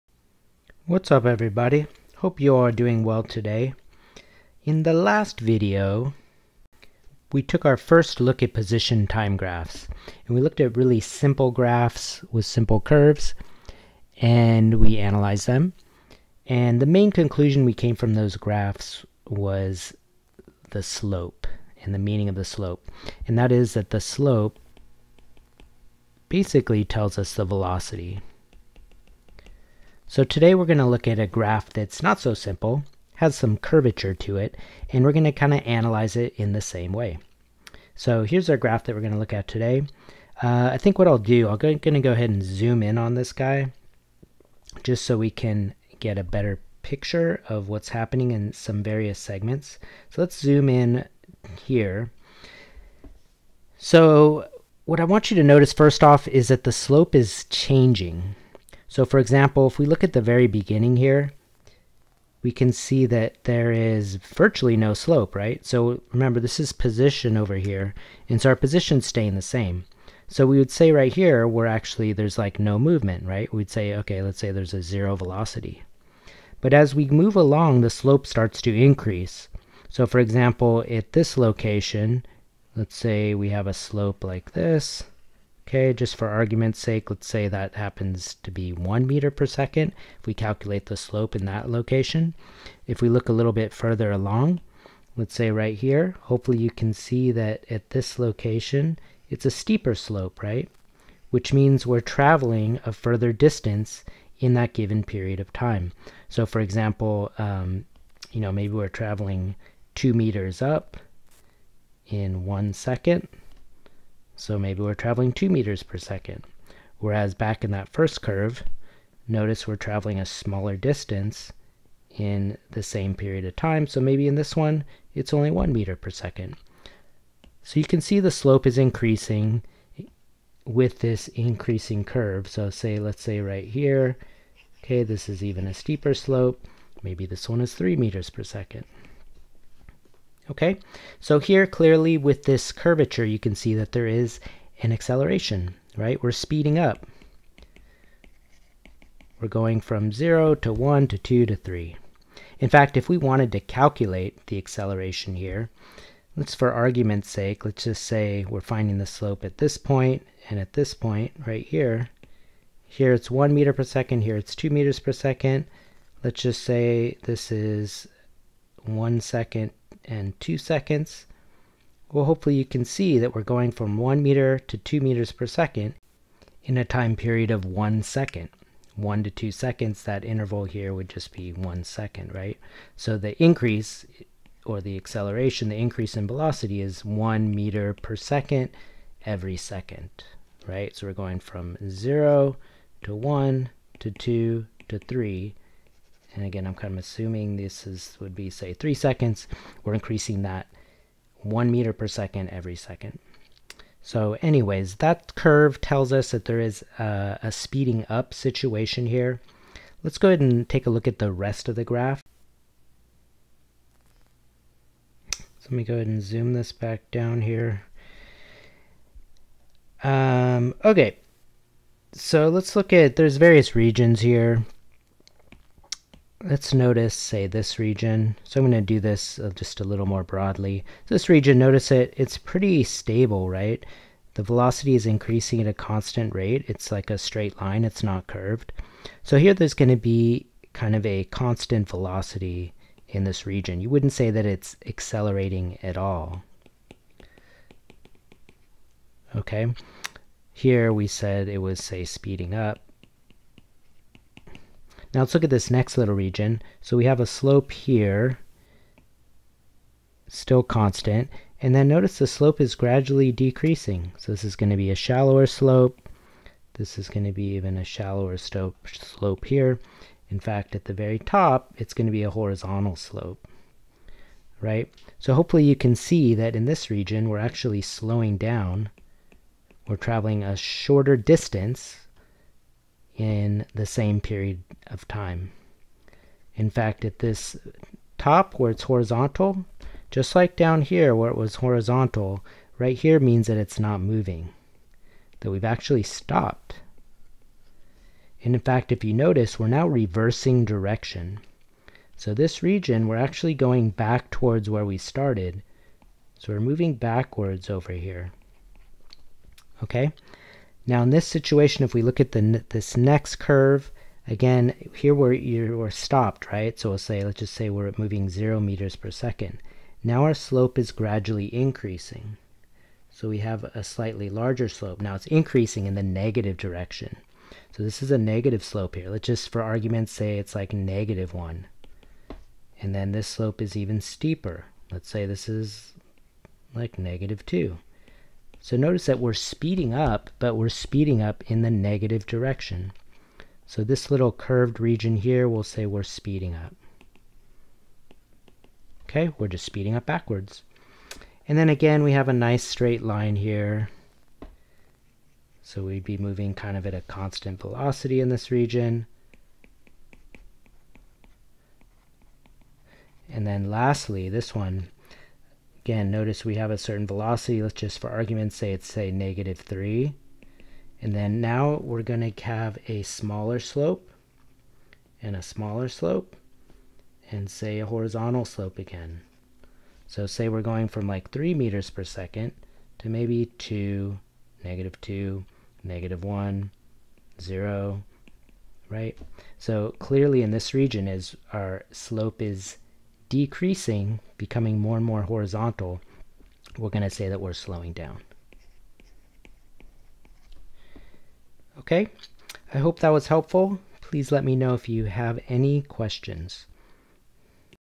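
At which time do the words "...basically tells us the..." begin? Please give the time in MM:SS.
00:26.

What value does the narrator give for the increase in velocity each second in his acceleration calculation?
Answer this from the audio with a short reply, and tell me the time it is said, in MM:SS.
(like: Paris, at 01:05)
1 meter per second every second, at 03:07.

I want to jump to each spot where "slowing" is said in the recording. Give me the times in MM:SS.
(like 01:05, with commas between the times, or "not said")
04:37, 06:37.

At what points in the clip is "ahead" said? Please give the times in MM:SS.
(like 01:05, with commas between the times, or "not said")
00:42, 03:30, 03:35.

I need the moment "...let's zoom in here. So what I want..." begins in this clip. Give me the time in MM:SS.
00:50.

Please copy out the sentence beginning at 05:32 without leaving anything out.
And then this slope is even steeper.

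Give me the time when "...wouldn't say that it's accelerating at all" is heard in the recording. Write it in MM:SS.
04:03.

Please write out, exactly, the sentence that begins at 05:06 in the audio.
So we're moving backwards over here.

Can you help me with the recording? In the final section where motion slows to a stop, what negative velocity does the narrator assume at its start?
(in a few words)
-3.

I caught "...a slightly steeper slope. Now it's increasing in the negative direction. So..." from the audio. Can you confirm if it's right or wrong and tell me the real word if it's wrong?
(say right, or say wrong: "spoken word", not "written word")
wrong: "larger", not "steeper".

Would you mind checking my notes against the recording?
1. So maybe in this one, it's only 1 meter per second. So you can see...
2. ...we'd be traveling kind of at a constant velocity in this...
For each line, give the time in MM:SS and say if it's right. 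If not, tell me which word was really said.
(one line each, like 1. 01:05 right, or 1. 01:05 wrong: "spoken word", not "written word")
1. 02:03 right
2. 05:55 wrong: "moving", not "traveling".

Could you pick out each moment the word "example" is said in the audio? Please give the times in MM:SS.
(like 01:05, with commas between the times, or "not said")
00:59, 01:20, 01:46.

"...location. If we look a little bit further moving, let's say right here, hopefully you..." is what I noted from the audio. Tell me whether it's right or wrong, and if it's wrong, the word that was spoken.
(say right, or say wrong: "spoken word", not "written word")
wrong: "along", not "moving".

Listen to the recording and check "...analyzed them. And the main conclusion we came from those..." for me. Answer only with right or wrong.
right.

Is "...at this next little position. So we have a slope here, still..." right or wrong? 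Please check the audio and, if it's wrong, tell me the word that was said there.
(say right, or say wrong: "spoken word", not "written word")
wrong: "region", not "position".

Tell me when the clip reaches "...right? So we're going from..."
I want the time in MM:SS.
03:10.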